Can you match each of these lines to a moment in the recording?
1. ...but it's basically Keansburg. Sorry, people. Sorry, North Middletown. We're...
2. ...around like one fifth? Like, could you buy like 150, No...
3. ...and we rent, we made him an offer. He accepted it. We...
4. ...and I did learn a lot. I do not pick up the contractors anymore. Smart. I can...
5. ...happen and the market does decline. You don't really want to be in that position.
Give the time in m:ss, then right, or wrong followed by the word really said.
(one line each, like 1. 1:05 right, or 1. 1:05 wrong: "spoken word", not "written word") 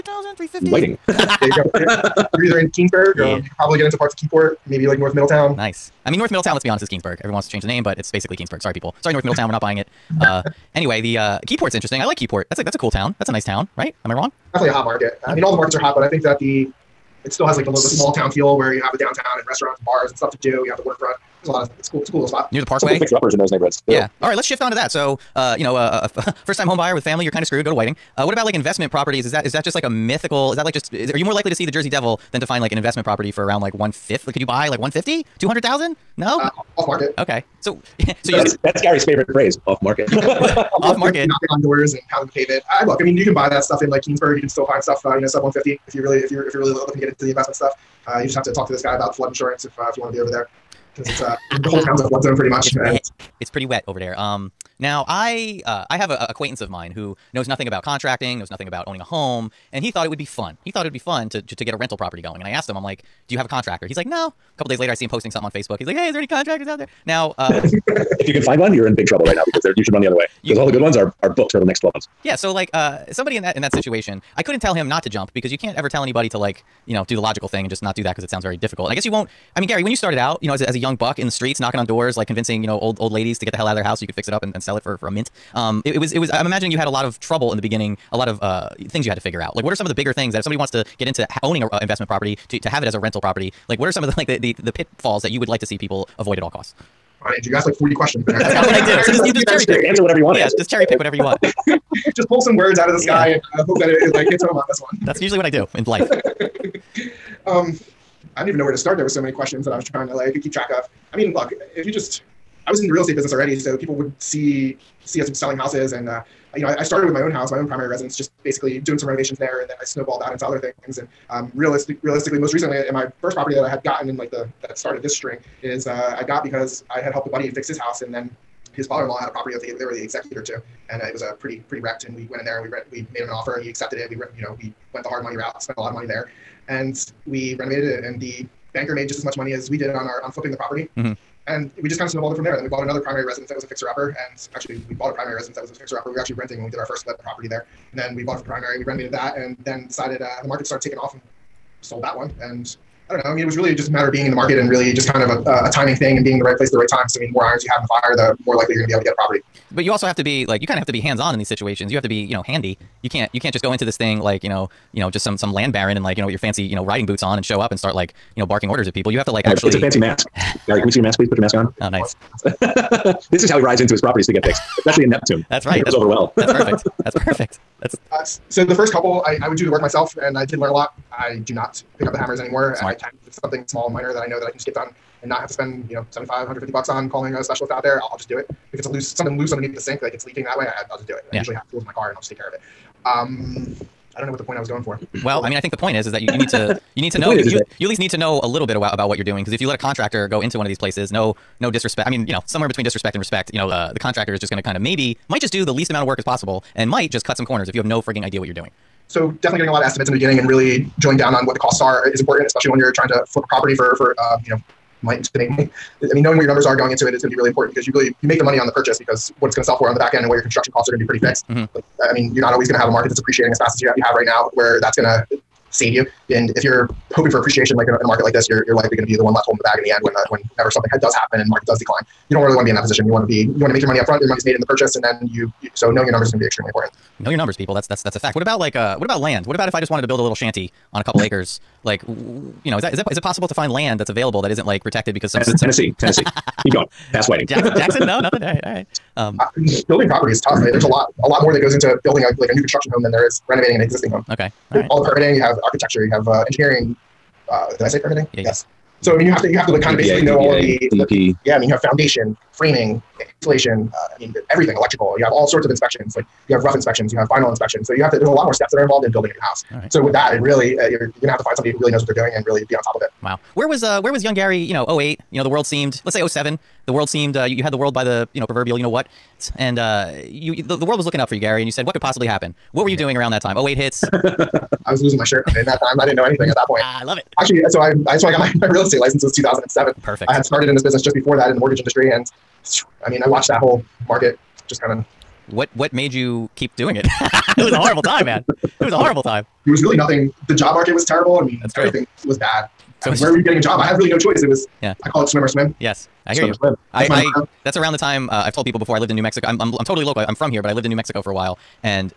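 1. 0:07 right
2. 0:33 right
3. 2:12 right
4. 3:00 wrong: "hammers", not "contractors"
5. 3:51 right.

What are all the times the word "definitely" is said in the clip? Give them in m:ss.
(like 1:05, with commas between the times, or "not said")
0:14, 3:29.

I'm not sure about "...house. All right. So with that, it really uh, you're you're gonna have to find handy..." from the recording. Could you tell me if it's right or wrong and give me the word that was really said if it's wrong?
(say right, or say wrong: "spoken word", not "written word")
wrong: "somebody", not "handy".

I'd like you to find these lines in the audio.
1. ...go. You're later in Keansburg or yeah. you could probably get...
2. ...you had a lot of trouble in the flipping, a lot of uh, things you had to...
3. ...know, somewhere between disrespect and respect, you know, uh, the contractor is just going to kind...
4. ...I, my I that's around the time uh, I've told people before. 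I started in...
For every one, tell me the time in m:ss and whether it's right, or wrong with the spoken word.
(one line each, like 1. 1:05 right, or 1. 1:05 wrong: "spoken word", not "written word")
1. 0:01 wrong: "either", not "later"
2. 1:26 wrong: "beginning", not "flipping"
3. 3:22 right
4. 5:07 wrong: "lived", not "started".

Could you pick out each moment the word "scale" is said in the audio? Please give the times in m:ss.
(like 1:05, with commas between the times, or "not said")
not said.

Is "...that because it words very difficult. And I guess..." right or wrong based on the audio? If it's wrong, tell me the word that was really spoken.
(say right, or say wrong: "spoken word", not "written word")
wrong: "sounds", not "words".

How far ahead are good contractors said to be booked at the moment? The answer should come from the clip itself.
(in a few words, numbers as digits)
12 months.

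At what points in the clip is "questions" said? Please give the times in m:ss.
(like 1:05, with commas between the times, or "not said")
1:37, 1:49.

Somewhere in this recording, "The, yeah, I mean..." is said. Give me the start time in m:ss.
4:20.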